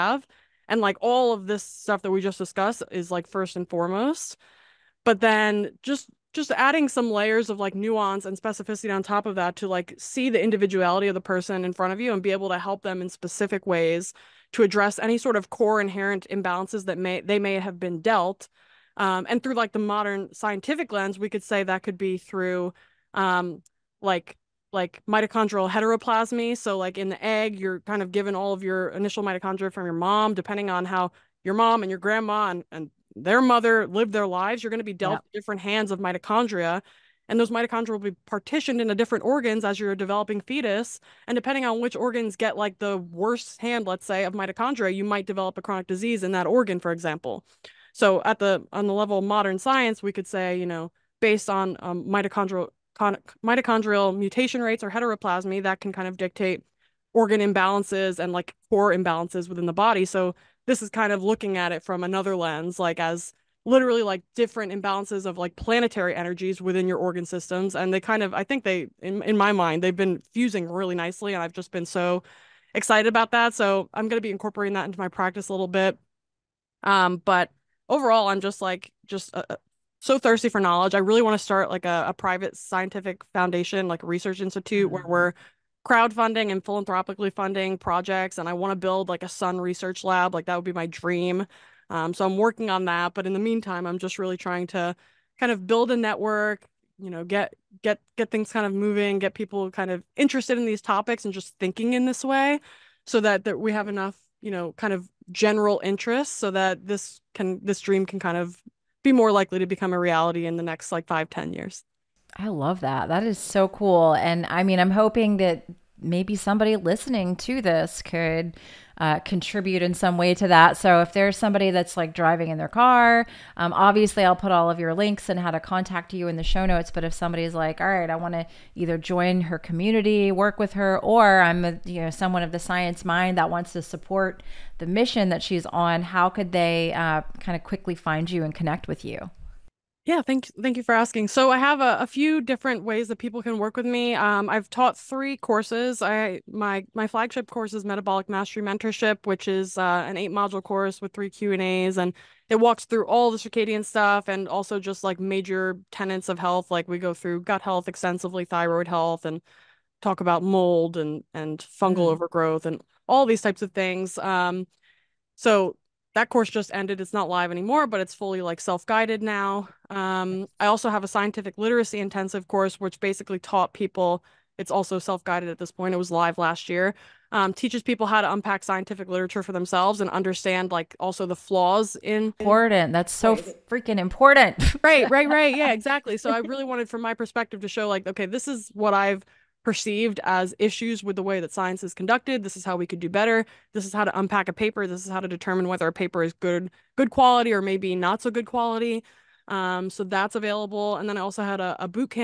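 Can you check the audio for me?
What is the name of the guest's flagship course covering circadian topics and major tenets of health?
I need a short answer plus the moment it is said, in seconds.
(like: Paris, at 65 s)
Metabolic Mastery Mentorship, at 147 s.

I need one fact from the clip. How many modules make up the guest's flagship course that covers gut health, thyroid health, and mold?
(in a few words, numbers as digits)
8.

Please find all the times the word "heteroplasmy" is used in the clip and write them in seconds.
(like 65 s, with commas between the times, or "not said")
25 s, 54 s.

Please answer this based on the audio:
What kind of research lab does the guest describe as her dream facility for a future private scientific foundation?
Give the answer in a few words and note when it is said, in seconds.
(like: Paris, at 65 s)
sun research lab, at 89 s.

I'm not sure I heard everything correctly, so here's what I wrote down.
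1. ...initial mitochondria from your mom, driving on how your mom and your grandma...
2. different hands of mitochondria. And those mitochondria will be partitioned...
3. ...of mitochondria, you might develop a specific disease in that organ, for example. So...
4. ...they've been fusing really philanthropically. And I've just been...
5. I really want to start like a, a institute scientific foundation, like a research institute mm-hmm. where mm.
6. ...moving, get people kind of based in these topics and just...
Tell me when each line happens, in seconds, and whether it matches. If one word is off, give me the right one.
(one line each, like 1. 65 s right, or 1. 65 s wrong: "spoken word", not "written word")
1. 28 s wrong: "depending", not "driving"
2. 35 s right
3. 44 s wrong: "chronic", not "specific"
4. 69 s wrong: "nicely", not "philanthropically"
5. 80 s wrong: "private", not "institute"
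6. 98 s wrong: "interested", not "based".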